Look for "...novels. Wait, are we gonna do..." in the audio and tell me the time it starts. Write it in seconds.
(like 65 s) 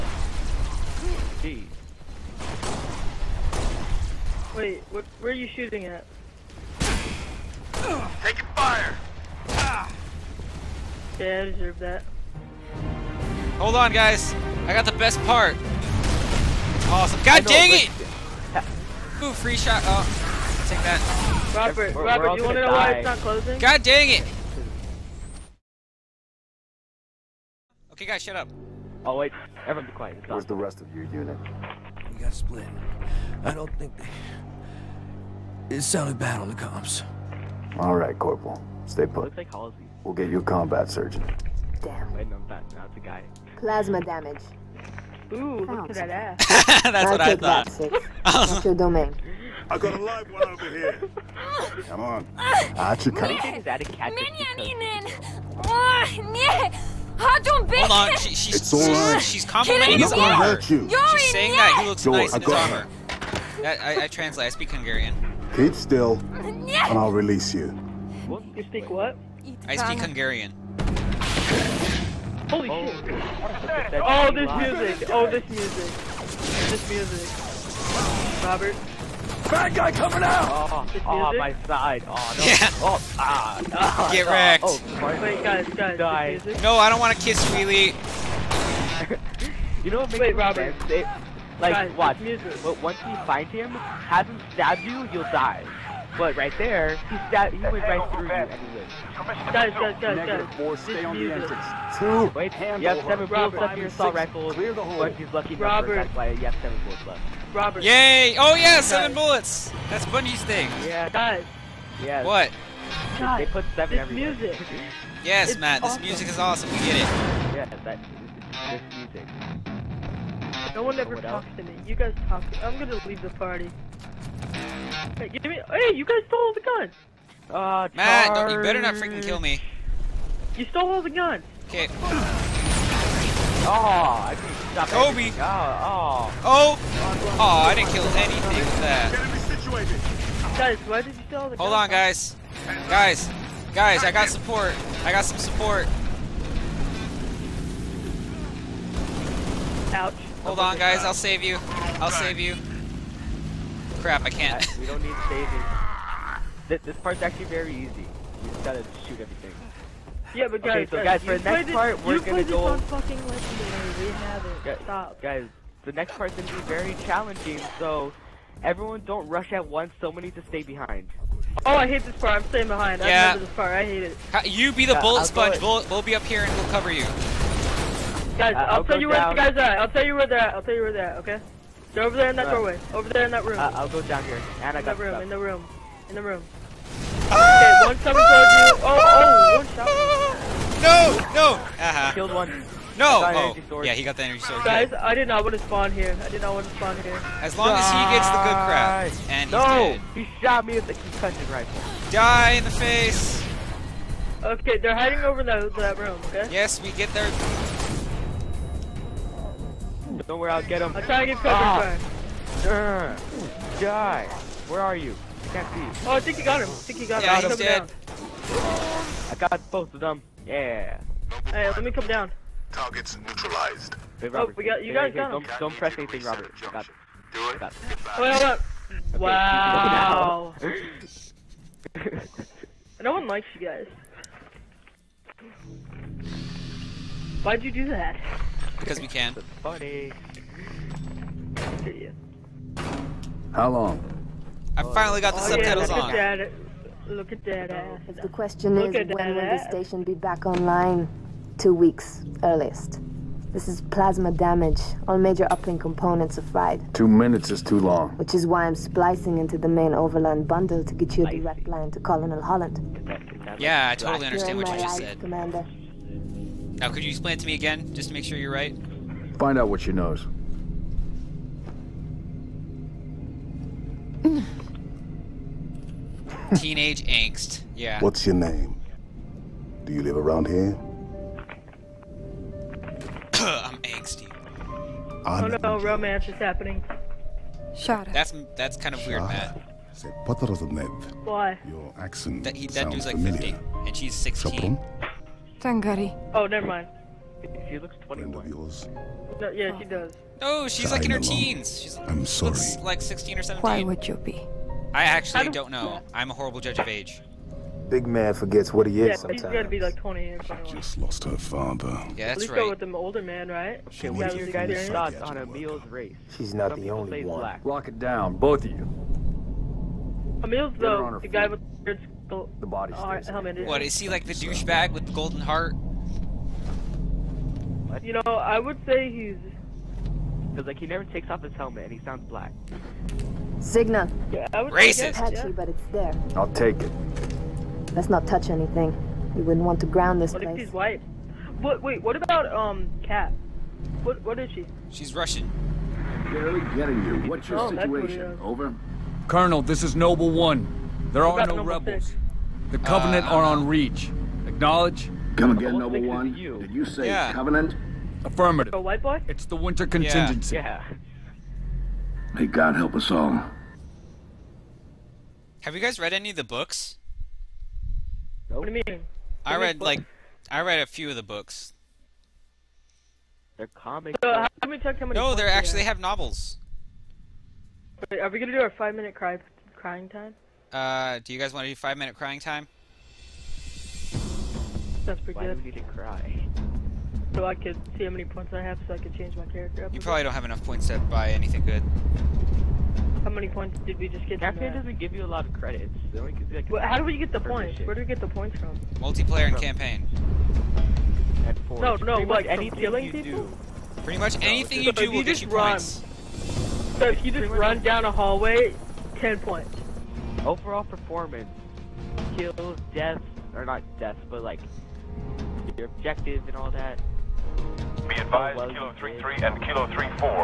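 375 s.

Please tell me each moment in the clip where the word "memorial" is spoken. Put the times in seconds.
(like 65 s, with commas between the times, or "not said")
not said.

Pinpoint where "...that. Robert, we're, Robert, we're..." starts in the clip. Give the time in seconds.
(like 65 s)
20 s.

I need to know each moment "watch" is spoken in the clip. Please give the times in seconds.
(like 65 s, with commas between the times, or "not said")
91 s.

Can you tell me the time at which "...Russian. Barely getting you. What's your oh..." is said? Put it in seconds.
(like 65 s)
345 s.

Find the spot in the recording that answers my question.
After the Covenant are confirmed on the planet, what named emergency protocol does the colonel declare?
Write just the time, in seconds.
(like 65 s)
359 s.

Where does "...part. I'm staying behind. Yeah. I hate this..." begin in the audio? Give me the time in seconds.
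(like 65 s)
172 s.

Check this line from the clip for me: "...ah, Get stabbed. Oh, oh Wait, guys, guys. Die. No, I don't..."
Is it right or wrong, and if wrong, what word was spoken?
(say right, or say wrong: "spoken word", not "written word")
wrong: "wrecked", not "stabbed".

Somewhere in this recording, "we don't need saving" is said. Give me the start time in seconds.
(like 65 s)
154 s.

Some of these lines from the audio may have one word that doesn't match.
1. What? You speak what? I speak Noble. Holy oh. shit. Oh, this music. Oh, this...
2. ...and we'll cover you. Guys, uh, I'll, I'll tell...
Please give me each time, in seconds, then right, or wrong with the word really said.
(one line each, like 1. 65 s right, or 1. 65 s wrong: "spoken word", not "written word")
1. 68 s wrong: "Hungarian", not "Noble"
2. 176 s right.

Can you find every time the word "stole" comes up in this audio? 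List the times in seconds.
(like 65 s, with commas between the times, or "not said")
126 s, 130 s.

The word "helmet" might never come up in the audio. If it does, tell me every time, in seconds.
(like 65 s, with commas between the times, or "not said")
323 s, 331 s.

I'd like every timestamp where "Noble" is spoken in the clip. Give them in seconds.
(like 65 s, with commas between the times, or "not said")
349 s, 355 s.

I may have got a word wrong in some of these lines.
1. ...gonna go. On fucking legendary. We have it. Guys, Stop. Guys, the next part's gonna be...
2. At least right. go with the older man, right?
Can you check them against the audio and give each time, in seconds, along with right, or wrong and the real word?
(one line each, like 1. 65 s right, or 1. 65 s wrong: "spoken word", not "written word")
1. 162 s right
2. 312 s right.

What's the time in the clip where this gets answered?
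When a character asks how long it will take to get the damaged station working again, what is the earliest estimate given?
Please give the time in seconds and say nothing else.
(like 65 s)
251 s.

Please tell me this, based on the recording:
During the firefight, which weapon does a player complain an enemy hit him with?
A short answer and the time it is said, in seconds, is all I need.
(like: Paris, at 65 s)
concussion rifle, at 200 s.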